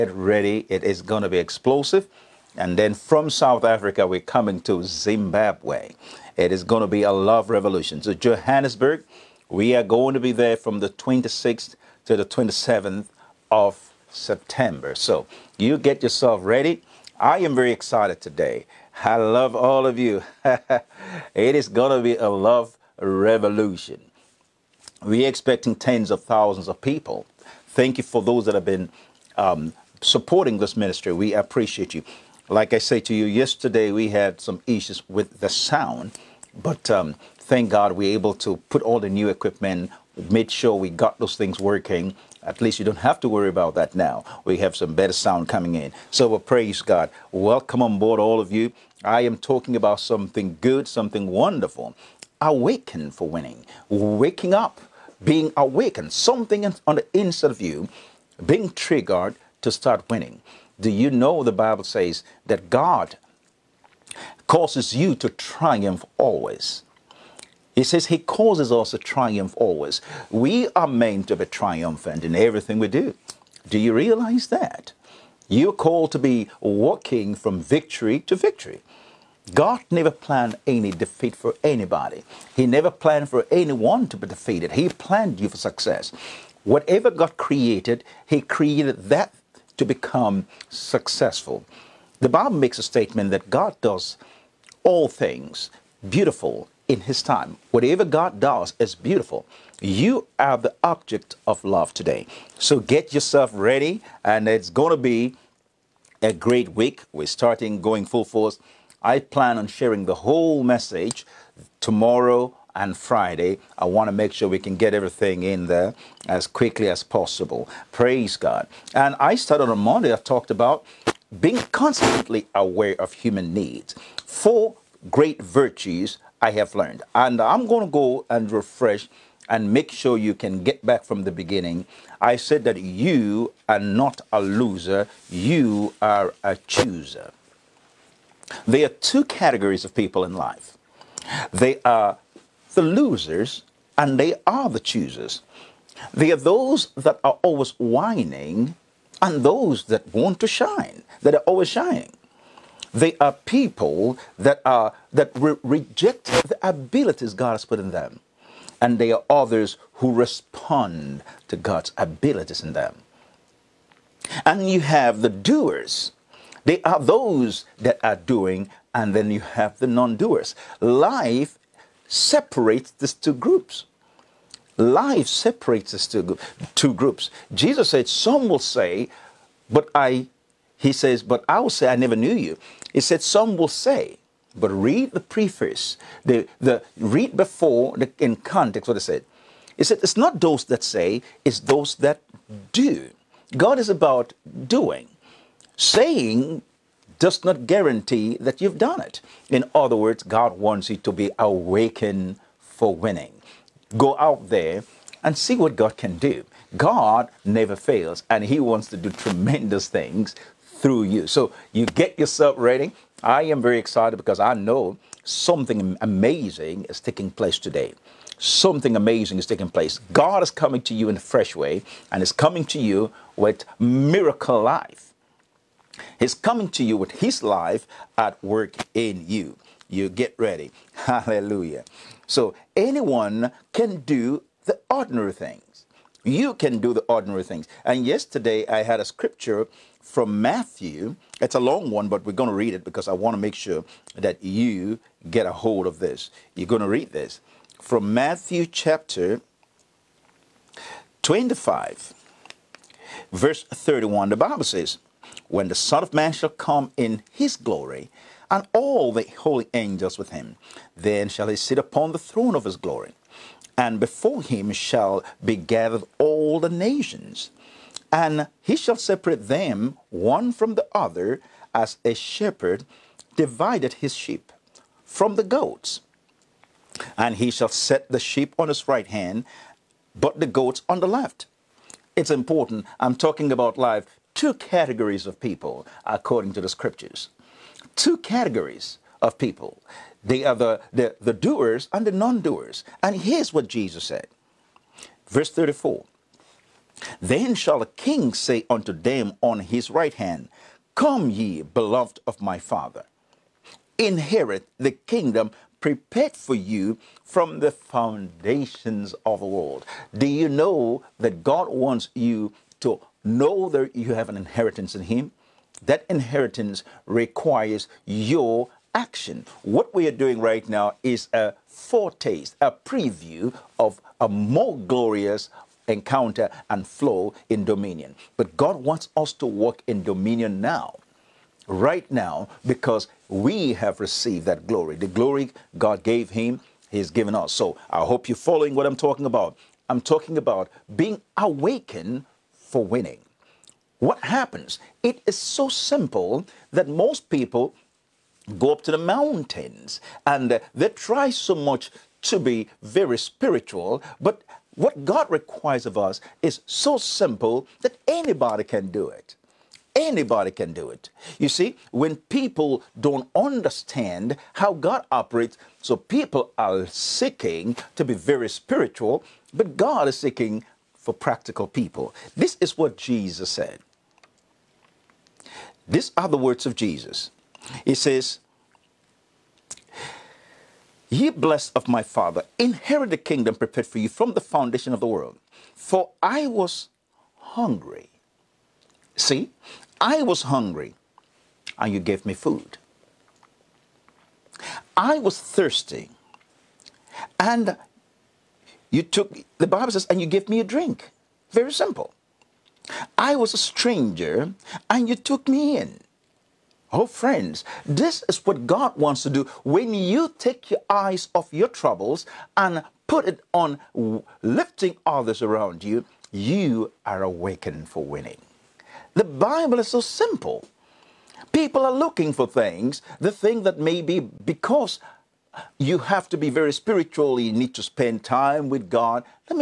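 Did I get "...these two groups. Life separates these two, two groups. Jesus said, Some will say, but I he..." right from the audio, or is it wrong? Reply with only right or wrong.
right.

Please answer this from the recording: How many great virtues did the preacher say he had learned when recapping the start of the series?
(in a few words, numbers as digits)
4.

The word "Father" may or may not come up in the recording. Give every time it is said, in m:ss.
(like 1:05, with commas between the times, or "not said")
5:02, 6:22.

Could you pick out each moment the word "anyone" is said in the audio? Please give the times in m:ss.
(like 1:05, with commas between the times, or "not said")
1:23, 3:52.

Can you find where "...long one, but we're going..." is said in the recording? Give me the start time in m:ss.
4:01.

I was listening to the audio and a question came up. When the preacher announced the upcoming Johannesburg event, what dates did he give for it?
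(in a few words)
26th to 27th of September.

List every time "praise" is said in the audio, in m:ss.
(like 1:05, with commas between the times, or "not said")
0:46, 1:57.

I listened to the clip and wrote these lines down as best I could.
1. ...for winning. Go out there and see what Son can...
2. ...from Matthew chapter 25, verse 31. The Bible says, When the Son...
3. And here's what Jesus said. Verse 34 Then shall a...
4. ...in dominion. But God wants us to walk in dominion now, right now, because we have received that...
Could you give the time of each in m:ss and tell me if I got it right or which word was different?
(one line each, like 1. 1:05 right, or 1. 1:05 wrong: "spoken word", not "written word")
1. 3:22 wrong: "God", not "Son"
2. 4:07 right
3. 4:53 right
4. 5:27 right.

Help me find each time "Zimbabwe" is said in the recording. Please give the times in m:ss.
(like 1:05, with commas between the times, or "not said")
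0:04.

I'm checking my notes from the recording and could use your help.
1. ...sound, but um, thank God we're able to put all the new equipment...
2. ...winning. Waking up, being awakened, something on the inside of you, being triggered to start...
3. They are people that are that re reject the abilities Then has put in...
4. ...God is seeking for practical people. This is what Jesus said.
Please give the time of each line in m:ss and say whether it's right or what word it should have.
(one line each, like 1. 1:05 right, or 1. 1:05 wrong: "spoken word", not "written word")
1. 0:35 right
2. 0:53 right
3. 2:32 wrong: "God", not "Then"
4. 6:09 right.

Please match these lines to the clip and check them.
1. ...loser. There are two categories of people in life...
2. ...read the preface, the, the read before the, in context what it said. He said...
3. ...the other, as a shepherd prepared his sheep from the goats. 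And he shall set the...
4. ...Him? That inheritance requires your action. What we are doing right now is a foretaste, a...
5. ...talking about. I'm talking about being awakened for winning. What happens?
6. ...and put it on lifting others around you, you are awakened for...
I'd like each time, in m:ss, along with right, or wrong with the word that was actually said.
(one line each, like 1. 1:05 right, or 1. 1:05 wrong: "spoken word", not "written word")
1. 2:16 wrong: "chooser", not "loser"
2. 3:04 right
3. 4:30 wrong: "divided", not "prepared"
4. 5:15 right
5. 5:38 right
6. 6:52 right.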